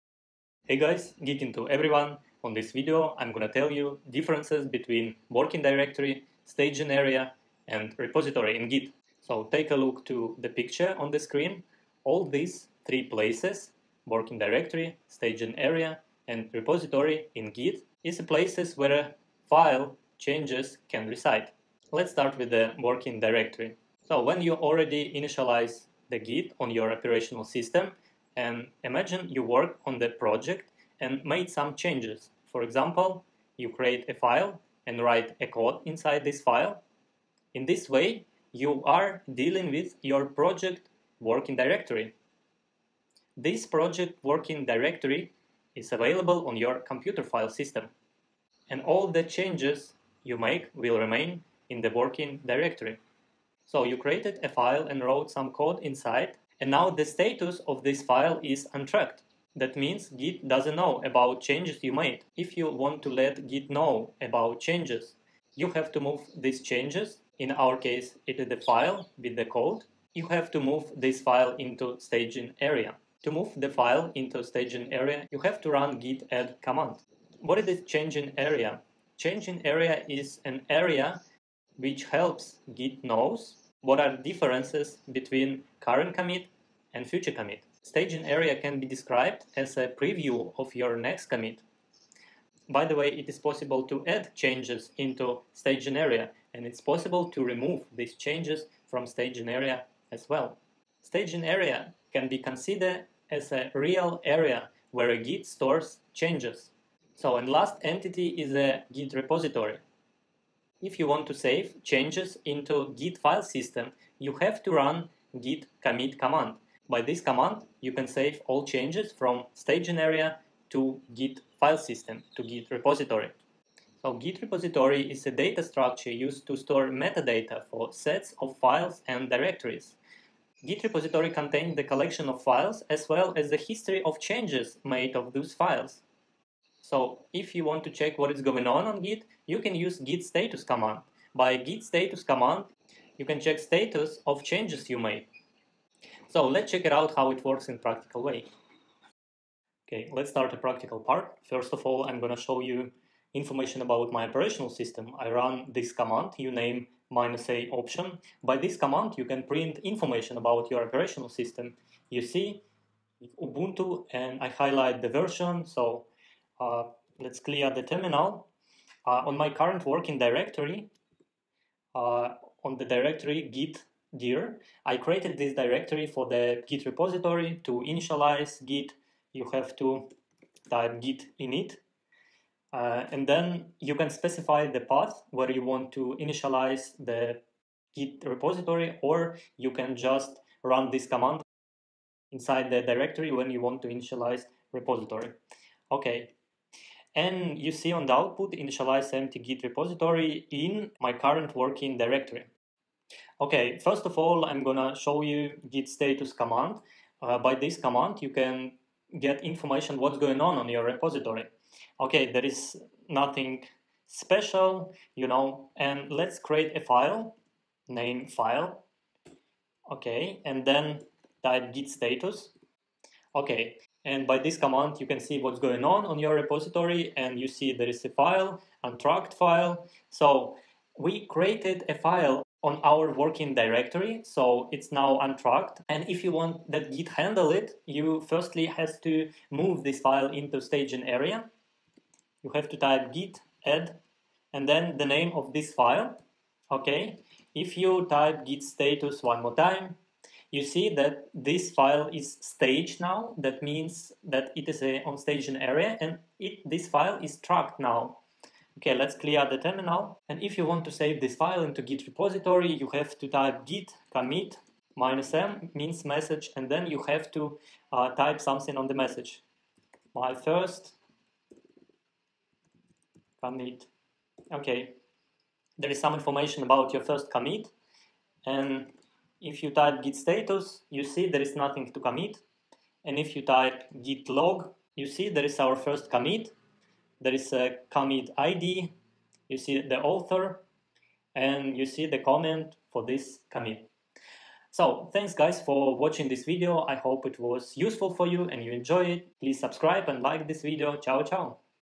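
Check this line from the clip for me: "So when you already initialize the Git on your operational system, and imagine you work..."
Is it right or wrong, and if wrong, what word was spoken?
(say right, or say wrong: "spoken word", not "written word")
right.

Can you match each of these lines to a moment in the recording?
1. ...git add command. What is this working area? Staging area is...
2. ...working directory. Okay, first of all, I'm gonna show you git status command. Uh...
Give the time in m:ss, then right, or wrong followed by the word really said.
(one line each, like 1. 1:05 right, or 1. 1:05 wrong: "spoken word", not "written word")
1. 1:15 wrong: "staging", not "working"
2. 3:21 right.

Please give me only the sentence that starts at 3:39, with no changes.
Okay, and then type git status.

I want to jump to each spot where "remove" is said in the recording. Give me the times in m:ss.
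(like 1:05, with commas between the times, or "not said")
1:37.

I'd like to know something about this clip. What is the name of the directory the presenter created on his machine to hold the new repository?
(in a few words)
git gear.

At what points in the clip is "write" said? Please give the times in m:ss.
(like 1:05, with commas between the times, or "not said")
0:35.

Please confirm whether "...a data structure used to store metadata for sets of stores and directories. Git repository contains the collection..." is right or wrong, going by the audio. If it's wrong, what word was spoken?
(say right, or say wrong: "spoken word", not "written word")
wrong: "files", not "stores".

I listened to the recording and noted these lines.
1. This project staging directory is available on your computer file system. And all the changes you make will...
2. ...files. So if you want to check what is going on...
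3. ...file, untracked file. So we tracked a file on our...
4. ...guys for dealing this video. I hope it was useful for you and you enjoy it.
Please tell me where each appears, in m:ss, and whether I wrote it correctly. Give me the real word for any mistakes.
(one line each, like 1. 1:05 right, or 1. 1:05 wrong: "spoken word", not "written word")
1. 0:43 wrong: "working", not "staging"
2. 2:15 right
3. 3:48 wrong: "created", not "tracked"
4. 4:55 wrong: "watching", not "dealing".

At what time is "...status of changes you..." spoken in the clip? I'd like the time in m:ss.
2:23.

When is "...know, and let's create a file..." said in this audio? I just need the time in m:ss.
3:35.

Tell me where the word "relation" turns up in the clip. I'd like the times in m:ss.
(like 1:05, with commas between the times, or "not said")
not said.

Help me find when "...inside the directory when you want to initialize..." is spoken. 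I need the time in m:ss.
3:12.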